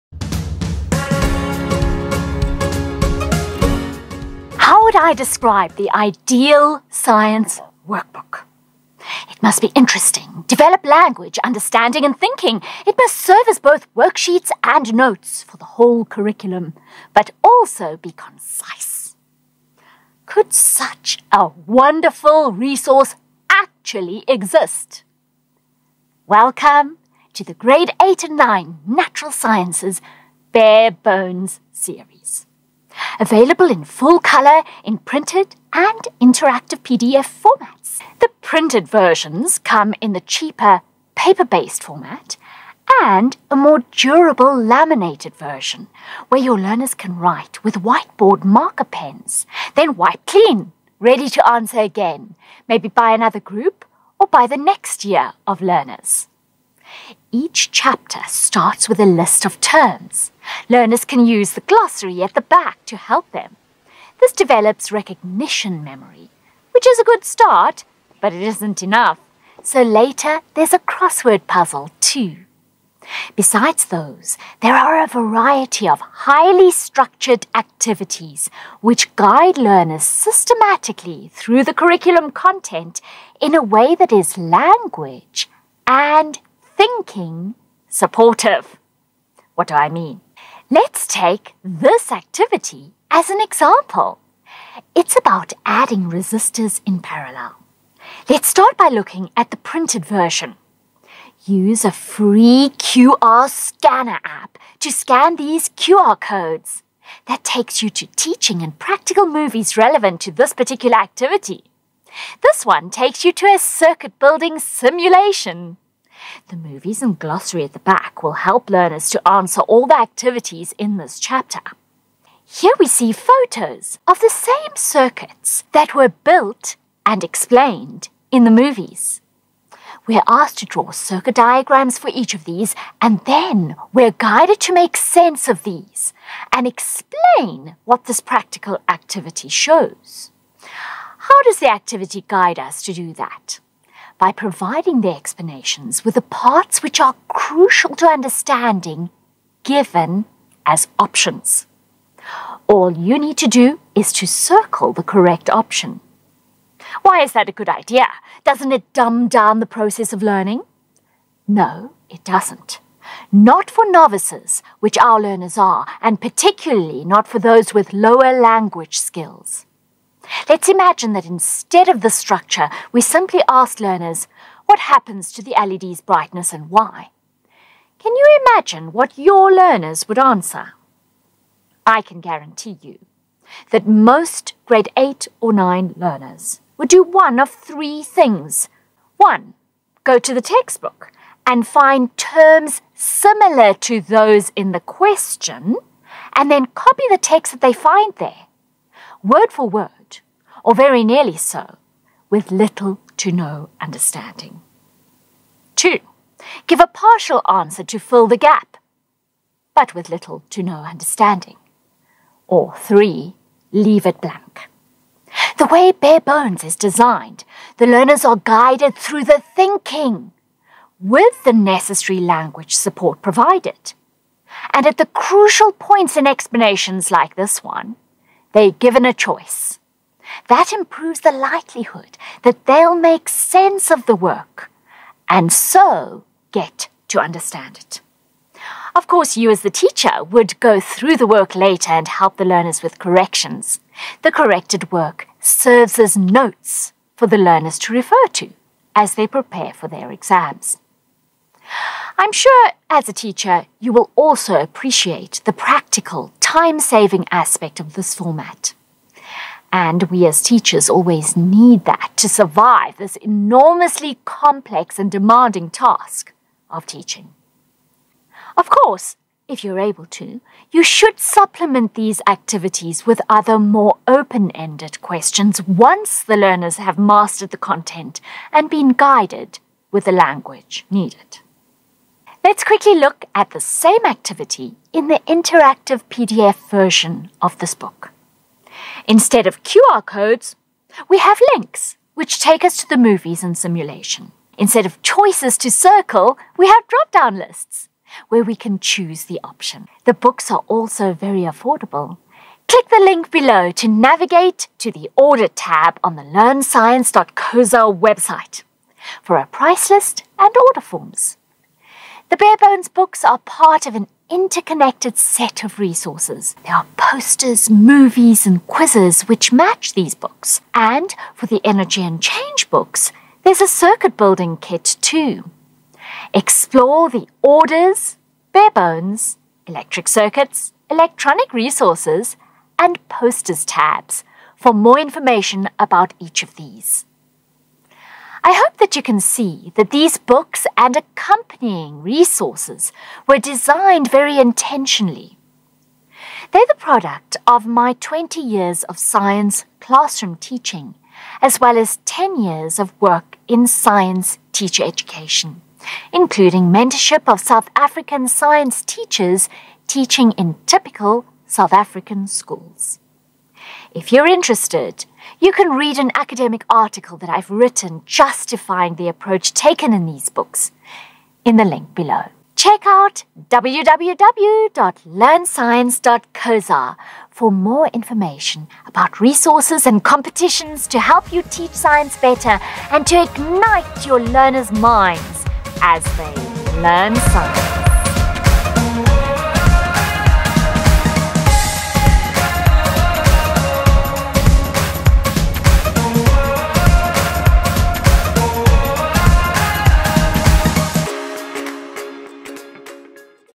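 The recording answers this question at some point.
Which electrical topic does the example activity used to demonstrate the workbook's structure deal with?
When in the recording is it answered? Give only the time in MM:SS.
01:35.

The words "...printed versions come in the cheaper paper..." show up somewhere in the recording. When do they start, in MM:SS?
00:38.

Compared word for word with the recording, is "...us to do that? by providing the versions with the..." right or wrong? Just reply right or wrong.
wrong.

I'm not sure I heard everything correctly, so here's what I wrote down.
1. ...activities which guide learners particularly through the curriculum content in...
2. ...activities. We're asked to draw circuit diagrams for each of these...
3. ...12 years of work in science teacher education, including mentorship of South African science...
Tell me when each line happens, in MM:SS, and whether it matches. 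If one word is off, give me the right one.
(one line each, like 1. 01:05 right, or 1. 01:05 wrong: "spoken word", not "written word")
1. 01:17 wrong: "systematically", not "particularly"
2. 02:08 wrong: "movies", not "activities"
3. 05:52 wrong: "10", not "12".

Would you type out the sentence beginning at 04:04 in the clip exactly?
The corrected work serves as notes for the learners to refer to as they prepare for their exams.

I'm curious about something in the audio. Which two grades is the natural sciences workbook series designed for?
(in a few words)
Grade 8 and 9.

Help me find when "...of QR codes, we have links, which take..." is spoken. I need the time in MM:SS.
04:49.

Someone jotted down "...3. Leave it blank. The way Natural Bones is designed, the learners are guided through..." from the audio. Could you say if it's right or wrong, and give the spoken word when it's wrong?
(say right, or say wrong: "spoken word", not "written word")
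wrong: "Bare", not "Natural".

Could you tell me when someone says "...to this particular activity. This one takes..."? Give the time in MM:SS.
01:50.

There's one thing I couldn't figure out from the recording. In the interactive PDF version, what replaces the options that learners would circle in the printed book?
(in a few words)
Drop down lists.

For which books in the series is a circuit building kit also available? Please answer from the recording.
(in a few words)
Energy and Change.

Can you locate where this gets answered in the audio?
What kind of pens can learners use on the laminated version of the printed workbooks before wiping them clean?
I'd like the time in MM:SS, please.
00:47.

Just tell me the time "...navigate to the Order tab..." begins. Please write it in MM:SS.
05:03.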